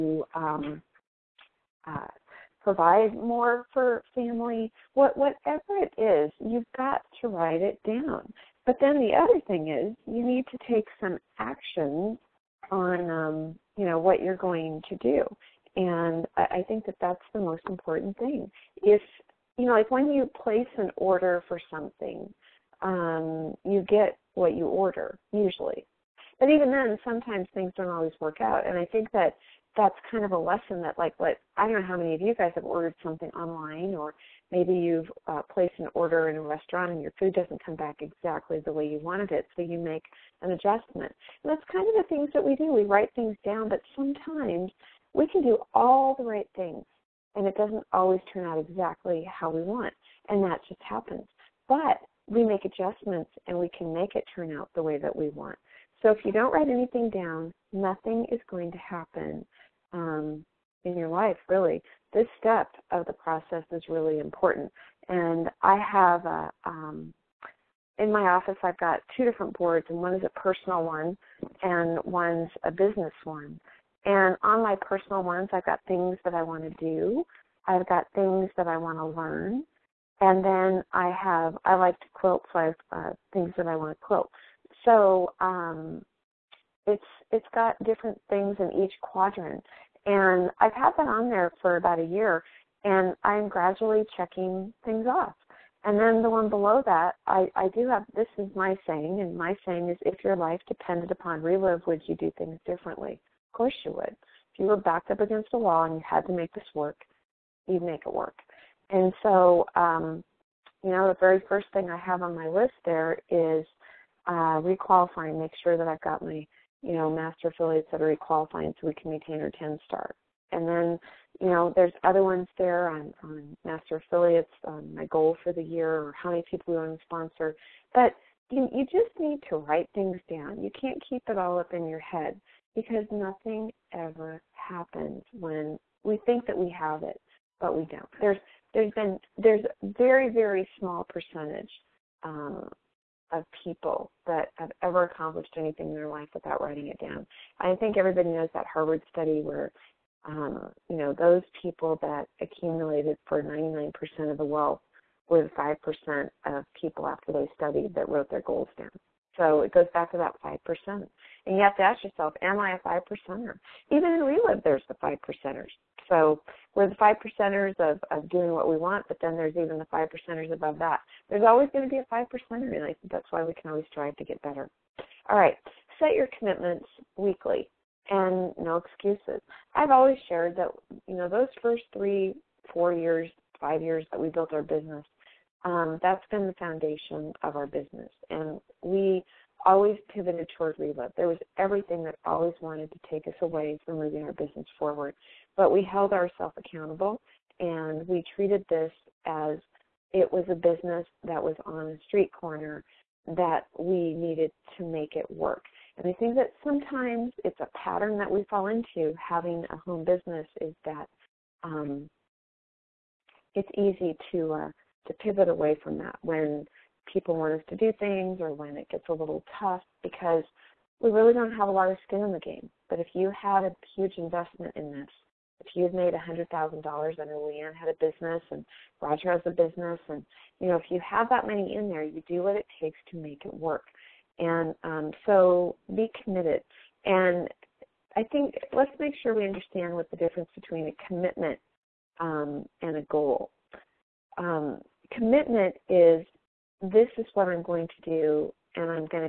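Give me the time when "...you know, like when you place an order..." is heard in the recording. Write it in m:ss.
0:19.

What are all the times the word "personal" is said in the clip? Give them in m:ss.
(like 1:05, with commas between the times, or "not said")
1:10, 1:14.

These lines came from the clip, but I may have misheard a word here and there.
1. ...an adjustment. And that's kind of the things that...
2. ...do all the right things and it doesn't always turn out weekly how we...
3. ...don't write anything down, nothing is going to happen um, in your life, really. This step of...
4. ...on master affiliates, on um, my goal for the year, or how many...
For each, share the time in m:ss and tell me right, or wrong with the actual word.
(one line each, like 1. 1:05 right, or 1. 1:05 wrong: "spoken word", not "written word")
1. 0:40 right
2. 0:45 wrong: "exactly", not "weekly"
3. 0:56 right
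4. 2:03 right.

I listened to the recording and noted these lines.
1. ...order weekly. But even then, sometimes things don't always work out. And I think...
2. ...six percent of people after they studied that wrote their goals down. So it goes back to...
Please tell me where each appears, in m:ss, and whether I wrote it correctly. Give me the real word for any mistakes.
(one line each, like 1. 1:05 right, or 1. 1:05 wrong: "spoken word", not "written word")
1. 0:24 wrong: "usually", not "weekly"
2. 2:35 wrong: "five", not "six".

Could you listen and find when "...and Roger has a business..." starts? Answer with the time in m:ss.
3:48.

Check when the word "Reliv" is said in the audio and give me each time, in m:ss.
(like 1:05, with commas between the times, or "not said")
1:41, 2:44, 3:10.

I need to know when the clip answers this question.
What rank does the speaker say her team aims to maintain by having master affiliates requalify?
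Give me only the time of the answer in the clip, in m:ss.
1:59.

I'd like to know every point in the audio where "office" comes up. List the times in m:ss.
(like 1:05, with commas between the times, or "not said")
1:08.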